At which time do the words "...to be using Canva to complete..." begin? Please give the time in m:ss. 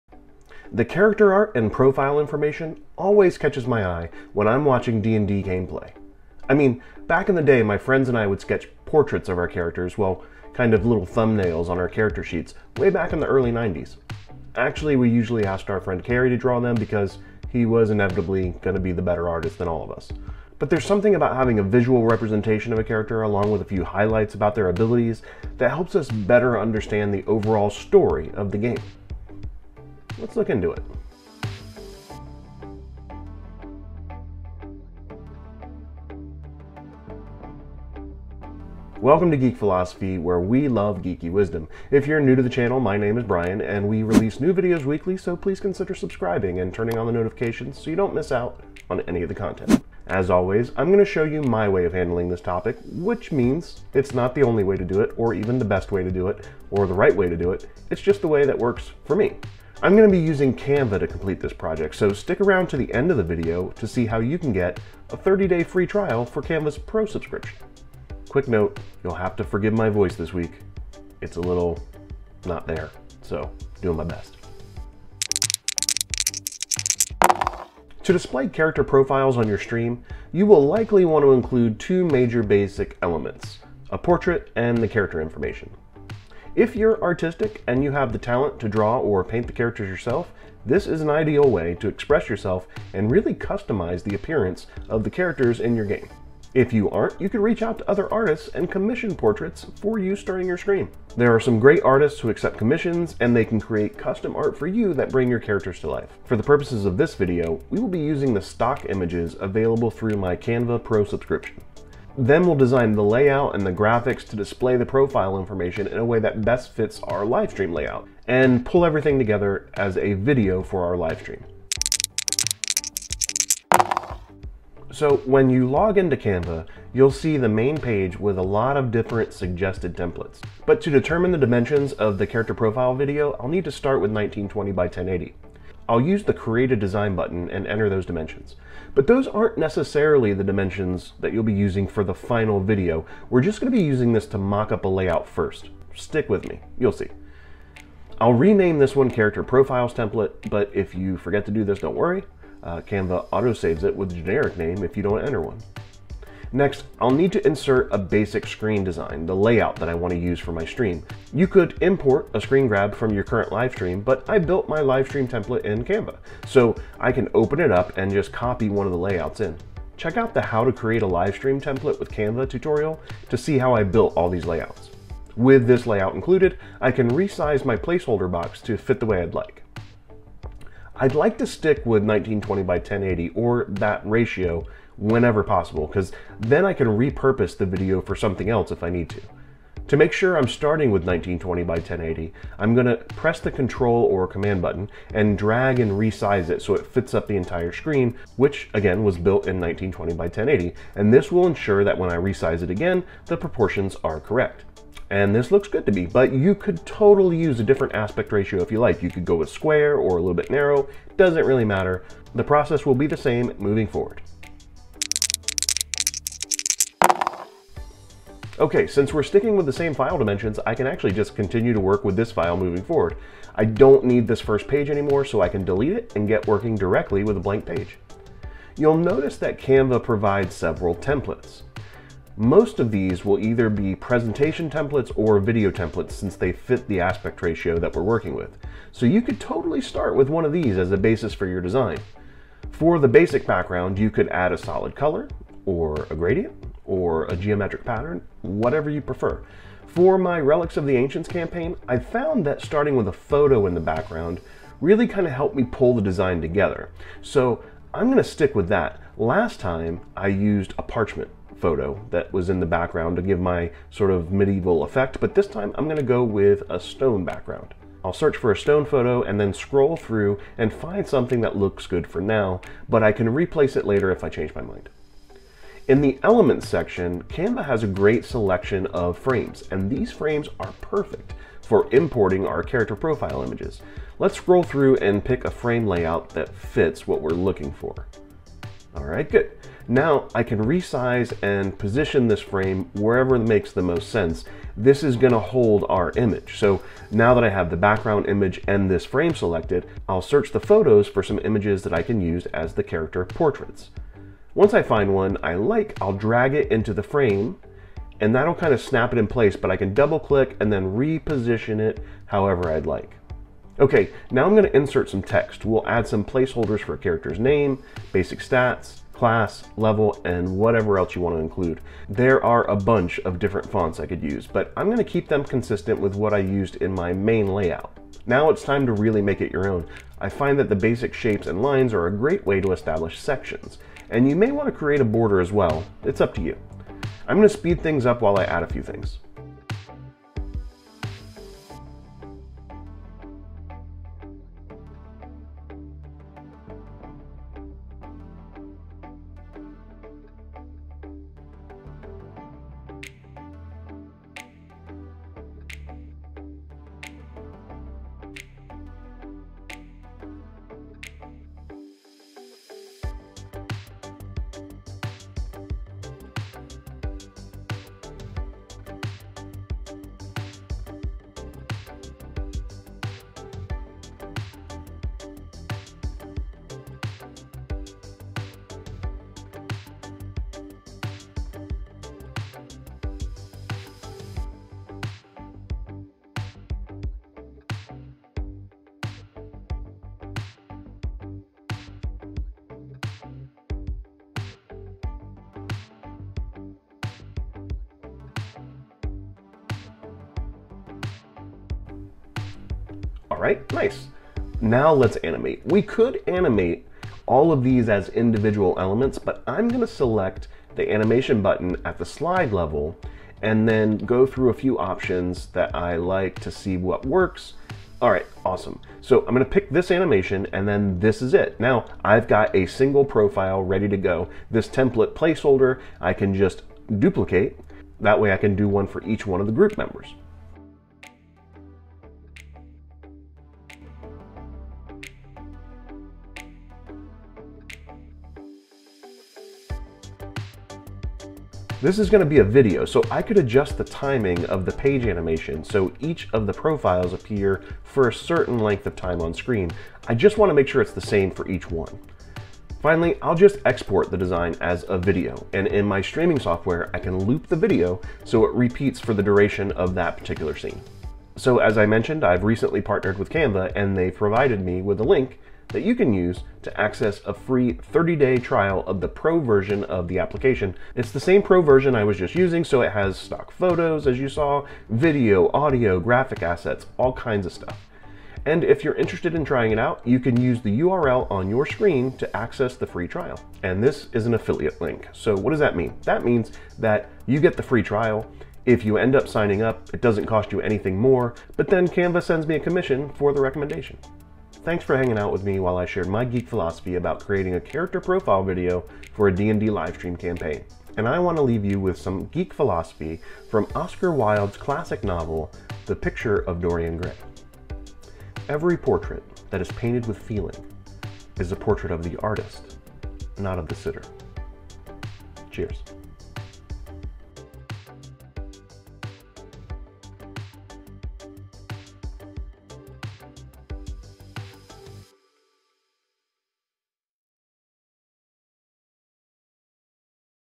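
1:00.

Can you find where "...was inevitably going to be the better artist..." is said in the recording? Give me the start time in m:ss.
0:17.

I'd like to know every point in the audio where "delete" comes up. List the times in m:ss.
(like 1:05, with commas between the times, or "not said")
3:45.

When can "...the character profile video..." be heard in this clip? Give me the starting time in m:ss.
2:12.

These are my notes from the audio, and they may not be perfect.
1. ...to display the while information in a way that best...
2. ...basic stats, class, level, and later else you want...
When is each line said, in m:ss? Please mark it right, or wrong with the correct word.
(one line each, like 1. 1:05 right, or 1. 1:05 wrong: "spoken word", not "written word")
1. 1:54 wrong: "profile", not "while"
2. 5:18 wrong: "whatever", not "later".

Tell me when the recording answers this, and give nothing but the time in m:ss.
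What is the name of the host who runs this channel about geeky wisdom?
0:43.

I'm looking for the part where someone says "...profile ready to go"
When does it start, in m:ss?
7:03.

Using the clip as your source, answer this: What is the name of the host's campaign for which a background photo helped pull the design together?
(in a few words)
Relics of the Ancients.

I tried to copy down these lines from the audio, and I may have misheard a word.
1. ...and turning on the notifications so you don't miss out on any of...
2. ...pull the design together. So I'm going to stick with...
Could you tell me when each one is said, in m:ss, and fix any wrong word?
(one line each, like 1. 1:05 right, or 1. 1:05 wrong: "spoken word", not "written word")
1. 0:46 right
2. 4:15 right.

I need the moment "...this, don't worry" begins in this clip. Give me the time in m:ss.
2:31.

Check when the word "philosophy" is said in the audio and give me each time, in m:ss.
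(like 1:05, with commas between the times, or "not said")
0:39, 8:16, 8:22.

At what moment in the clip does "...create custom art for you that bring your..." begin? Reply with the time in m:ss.
1:43.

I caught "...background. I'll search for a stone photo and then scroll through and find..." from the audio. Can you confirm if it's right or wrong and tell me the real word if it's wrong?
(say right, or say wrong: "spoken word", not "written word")
right.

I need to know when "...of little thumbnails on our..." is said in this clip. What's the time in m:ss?
0:10.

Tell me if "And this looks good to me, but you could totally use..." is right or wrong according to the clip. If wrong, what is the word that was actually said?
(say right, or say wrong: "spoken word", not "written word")
right.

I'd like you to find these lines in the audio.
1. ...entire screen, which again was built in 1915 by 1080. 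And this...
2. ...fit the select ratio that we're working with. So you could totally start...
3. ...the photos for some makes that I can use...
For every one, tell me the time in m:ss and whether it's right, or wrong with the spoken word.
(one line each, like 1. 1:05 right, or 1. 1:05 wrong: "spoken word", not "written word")
1. 3:17 wrong: "1920", not "1915"
2. 3:56 wrong: "aspect", not "select"
3. 5:00 wrong: "images", not "makes".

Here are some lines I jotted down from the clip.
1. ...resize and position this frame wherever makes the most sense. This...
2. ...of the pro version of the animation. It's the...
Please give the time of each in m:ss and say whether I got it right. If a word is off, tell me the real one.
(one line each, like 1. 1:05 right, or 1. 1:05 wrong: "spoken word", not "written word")
1. 4:50 right
2. 7:48 wrong: "application", not "animation".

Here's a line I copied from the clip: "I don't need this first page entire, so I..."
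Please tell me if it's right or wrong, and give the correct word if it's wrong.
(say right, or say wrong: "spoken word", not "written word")
wrong: "anymore", not "entire".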